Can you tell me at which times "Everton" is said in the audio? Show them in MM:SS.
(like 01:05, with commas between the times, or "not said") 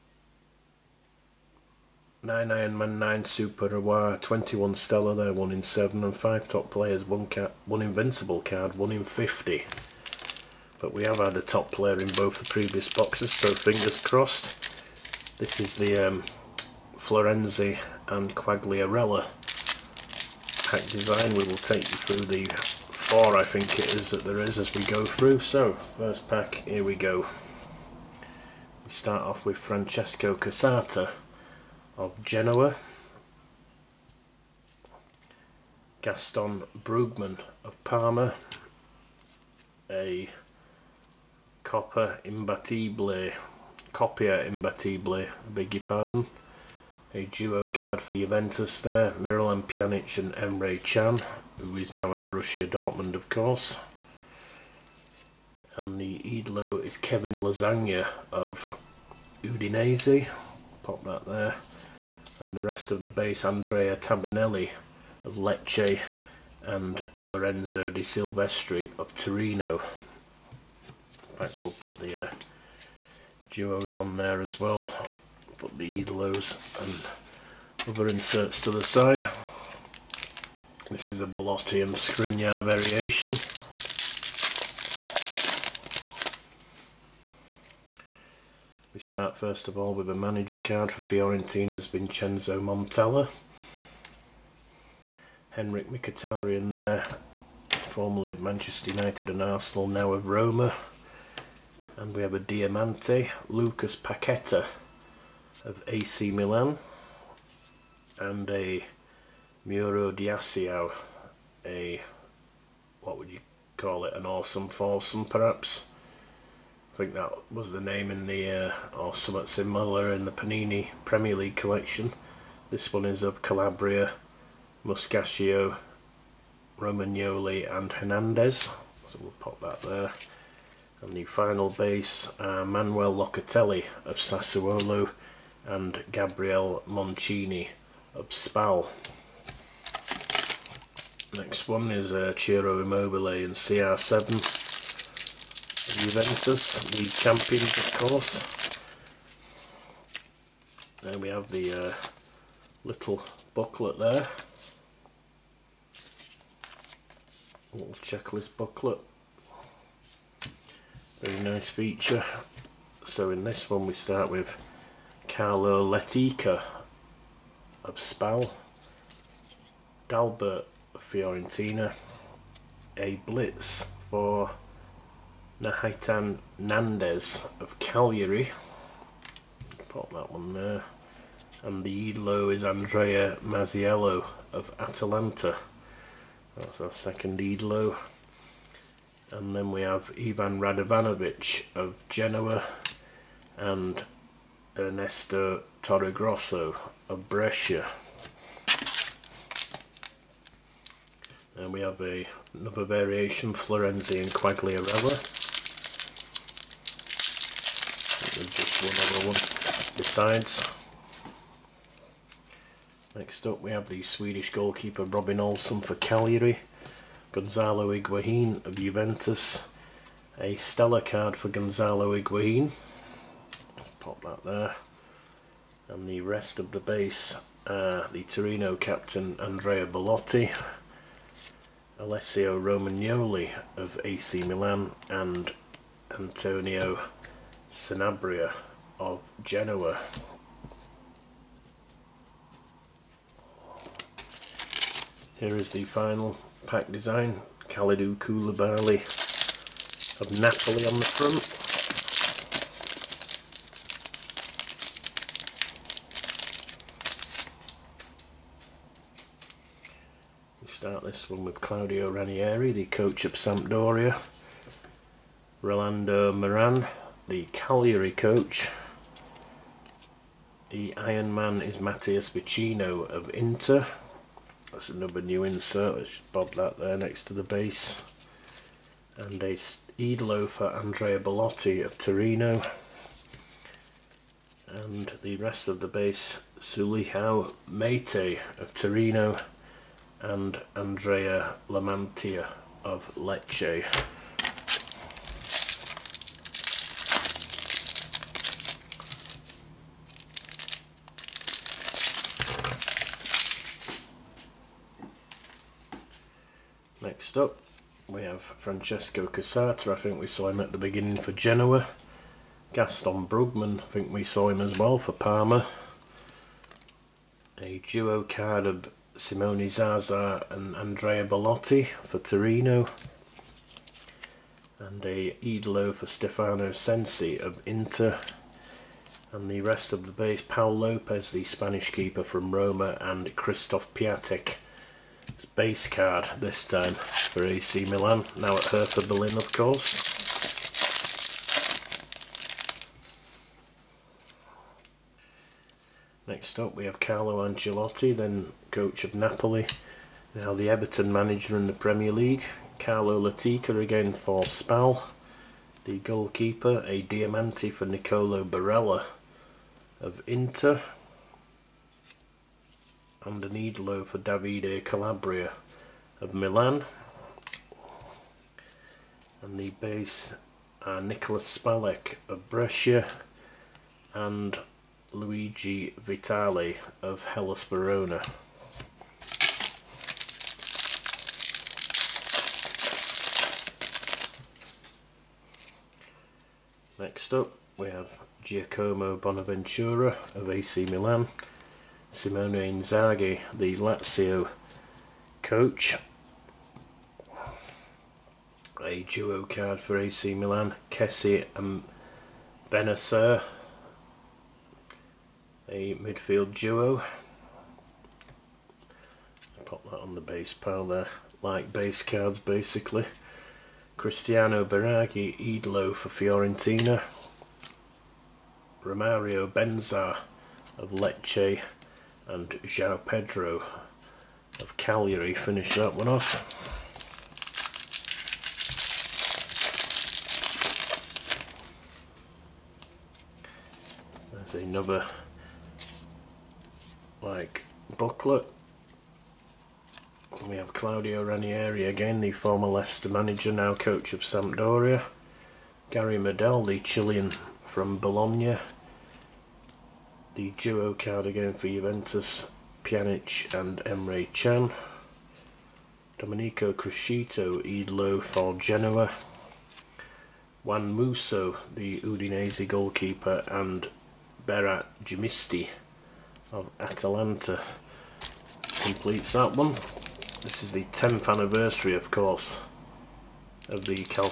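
05:50.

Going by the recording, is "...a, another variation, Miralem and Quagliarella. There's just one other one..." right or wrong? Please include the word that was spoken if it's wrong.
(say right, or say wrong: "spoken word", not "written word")
wrong: "Florenzi", not "Miralem".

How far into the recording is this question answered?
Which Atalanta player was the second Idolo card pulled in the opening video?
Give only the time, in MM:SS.
03:02.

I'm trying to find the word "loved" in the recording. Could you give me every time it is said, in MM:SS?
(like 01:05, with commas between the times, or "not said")
not said.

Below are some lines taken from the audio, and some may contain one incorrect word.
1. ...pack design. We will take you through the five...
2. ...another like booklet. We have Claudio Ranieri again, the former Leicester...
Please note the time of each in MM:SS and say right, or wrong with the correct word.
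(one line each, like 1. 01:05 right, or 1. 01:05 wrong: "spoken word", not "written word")
1. 00:20 wrong: "four", not "five"
2. 07:14 right.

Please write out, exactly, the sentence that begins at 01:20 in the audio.
This is a Bellotti and Skriniar variation.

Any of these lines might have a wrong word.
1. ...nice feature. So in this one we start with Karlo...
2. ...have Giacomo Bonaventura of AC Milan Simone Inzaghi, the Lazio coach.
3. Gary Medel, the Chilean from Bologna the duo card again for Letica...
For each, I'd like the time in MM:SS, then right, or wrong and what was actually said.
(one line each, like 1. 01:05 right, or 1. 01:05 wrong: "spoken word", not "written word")
1. 02:41 right
2. 06:27 right
3. 07:25 wrong: "Juventus", not "Letica".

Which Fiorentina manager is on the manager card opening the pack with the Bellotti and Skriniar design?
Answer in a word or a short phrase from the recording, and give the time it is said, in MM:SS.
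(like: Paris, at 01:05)
Vincenzo Montella, at 01:31.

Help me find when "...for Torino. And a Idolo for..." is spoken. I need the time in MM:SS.
05:22.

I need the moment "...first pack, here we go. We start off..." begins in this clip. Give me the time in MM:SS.
00:25.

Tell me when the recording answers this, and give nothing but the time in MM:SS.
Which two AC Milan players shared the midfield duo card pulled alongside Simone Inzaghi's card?
06:40.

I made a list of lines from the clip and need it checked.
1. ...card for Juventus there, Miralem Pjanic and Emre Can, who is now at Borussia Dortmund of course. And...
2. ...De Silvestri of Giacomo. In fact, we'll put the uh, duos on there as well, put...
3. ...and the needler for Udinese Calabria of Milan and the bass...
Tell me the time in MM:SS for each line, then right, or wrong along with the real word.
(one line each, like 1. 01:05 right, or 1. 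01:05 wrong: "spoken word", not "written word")
1. 00:47 right
2. 01:07 wrong: "Torino", not "Giacomo"
3. 06:03 wrong: "Davide", not "Udinese".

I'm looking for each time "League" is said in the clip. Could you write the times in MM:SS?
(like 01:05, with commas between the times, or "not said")
02:01, 05:52.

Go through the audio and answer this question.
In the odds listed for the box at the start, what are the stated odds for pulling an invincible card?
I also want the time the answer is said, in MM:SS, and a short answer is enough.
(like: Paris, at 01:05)
1 in 50, at 00:08.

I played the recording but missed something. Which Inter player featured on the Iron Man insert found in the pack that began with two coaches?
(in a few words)
Matías Vecino.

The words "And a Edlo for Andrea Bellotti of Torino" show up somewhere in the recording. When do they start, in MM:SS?
04:39.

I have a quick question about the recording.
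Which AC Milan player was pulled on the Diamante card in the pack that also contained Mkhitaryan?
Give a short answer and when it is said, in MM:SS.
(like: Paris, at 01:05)
Lucas Paqueta, at 01:43.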